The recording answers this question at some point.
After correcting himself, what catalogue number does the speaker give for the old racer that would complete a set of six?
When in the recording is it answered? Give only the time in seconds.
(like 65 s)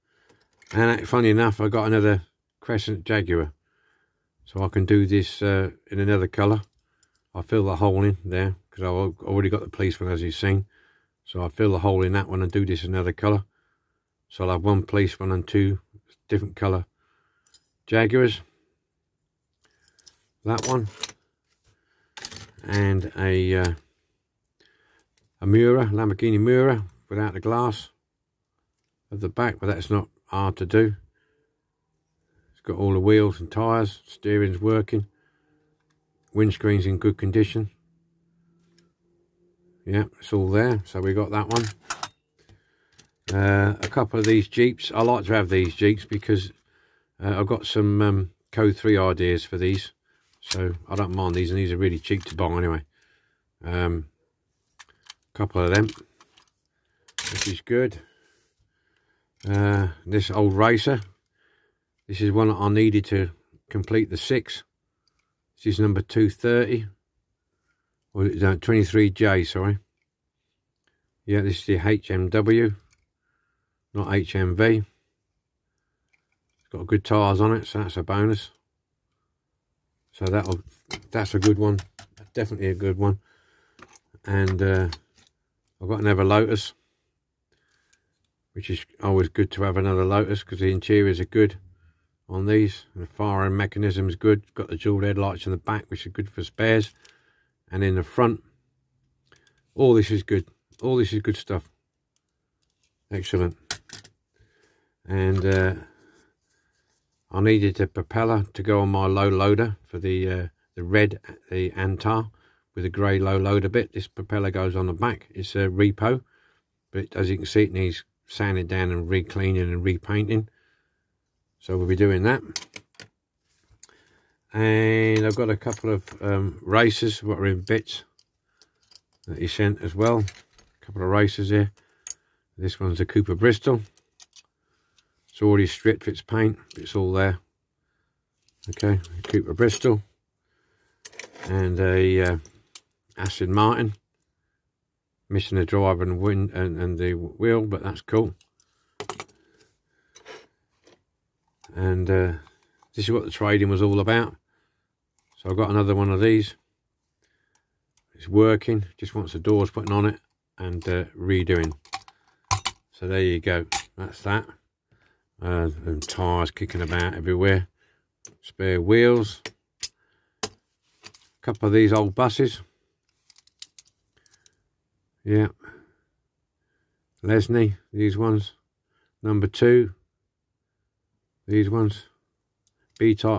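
68 s.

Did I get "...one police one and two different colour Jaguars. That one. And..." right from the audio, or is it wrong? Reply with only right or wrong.
right.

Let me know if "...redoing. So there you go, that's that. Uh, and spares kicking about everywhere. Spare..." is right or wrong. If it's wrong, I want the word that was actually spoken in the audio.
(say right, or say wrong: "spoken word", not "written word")
wrong: "tyres", not "spares".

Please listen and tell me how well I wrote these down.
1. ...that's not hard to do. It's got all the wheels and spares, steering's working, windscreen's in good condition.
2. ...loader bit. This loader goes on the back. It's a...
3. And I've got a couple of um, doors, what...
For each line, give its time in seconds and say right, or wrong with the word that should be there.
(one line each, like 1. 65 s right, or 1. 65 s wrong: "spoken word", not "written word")
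1. 29 s wrong: "tyres", not "spares"
2. 113 s wrong: "propeller", not "loader"
3. 124 s wrong: "racers", not "doors".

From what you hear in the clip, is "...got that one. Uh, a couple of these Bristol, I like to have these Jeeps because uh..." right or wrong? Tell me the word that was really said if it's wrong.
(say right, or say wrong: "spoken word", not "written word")
wrong: "Jeeps", not "Bristol".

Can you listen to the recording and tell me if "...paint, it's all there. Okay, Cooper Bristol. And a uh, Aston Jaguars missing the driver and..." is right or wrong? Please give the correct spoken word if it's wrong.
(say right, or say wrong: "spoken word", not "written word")
wrong: "Martin", not "Jaguars".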